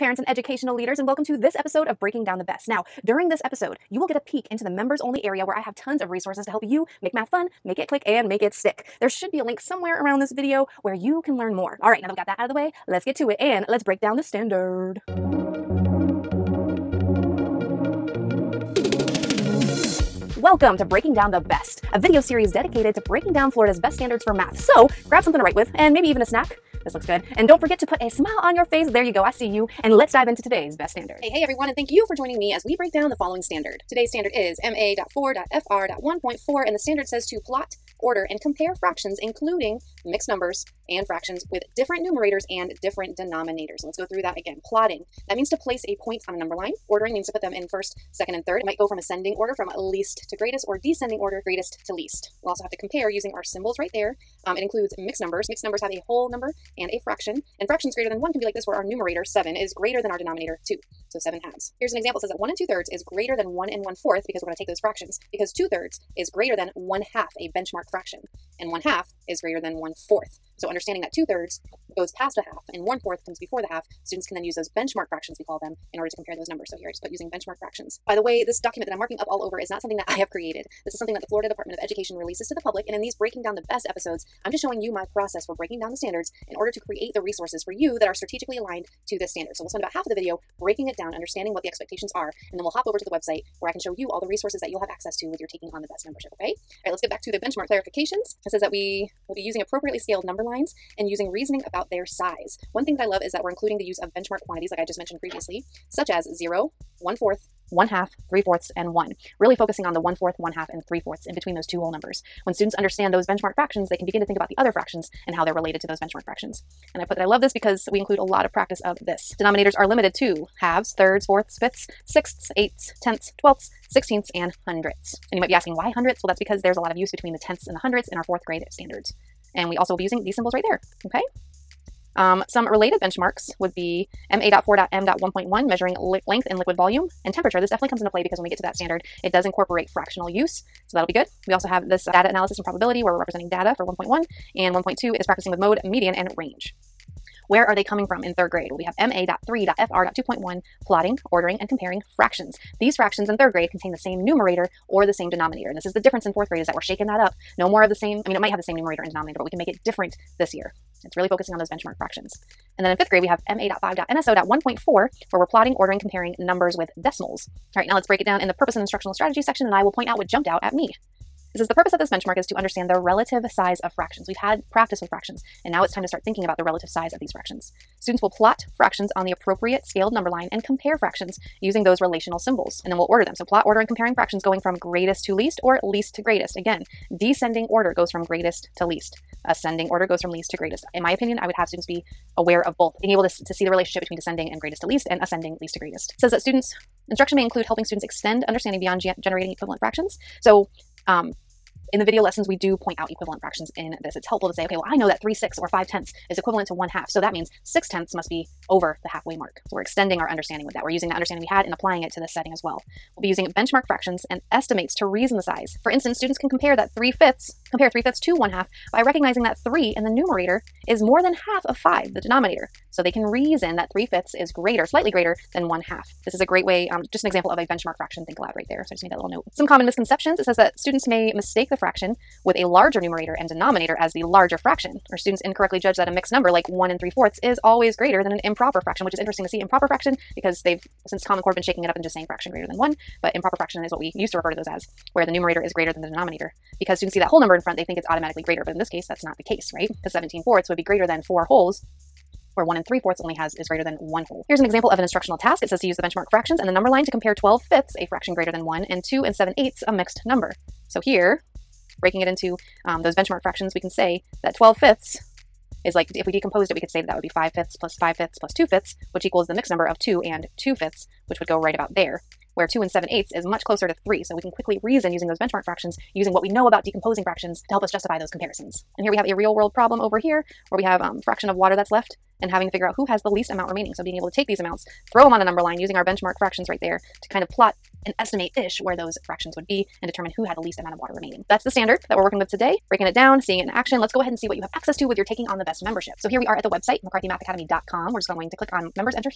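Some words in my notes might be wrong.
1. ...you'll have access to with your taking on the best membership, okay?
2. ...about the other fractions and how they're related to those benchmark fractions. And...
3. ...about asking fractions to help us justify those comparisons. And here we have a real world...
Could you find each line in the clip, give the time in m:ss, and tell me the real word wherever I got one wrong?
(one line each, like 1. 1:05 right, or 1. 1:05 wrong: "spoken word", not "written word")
1. 1:34 right
2. 1:54 right
3. 4:36 wrong: "decomposing", not "asking".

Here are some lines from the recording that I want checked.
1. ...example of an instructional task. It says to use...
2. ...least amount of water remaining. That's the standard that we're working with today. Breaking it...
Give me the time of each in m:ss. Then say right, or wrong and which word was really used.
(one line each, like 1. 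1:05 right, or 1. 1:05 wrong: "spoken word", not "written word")
1. 4:14 right
2. 4:50 right.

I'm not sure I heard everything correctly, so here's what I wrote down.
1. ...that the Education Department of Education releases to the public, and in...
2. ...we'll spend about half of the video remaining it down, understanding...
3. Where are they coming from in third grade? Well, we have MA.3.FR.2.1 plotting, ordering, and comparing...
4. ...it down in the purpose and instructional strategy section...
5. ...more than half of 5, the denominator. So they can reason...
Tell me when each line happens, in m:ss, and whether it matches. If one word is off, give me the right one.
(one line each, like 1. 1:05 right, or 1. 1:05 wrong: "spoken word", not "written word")
1. 1:21 wrong: "Florida", not "Education"
2. 1:29 wrong: "breaking", not "remaining"
3. 2:27 right
4. 2:48 right
5. 3:41 right.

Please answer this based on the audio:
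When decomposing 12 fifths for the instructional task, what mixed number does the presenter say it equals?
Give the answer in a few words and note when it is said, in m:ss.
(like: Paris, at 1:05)
2 and 2 fifths, at 4:30.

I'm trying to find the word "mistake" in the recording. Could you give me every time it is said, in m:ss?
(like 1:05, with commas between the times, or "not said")
3:51.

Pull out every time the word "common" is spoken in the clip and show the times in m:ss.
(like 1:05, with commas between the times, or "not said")
3:49, 4:01.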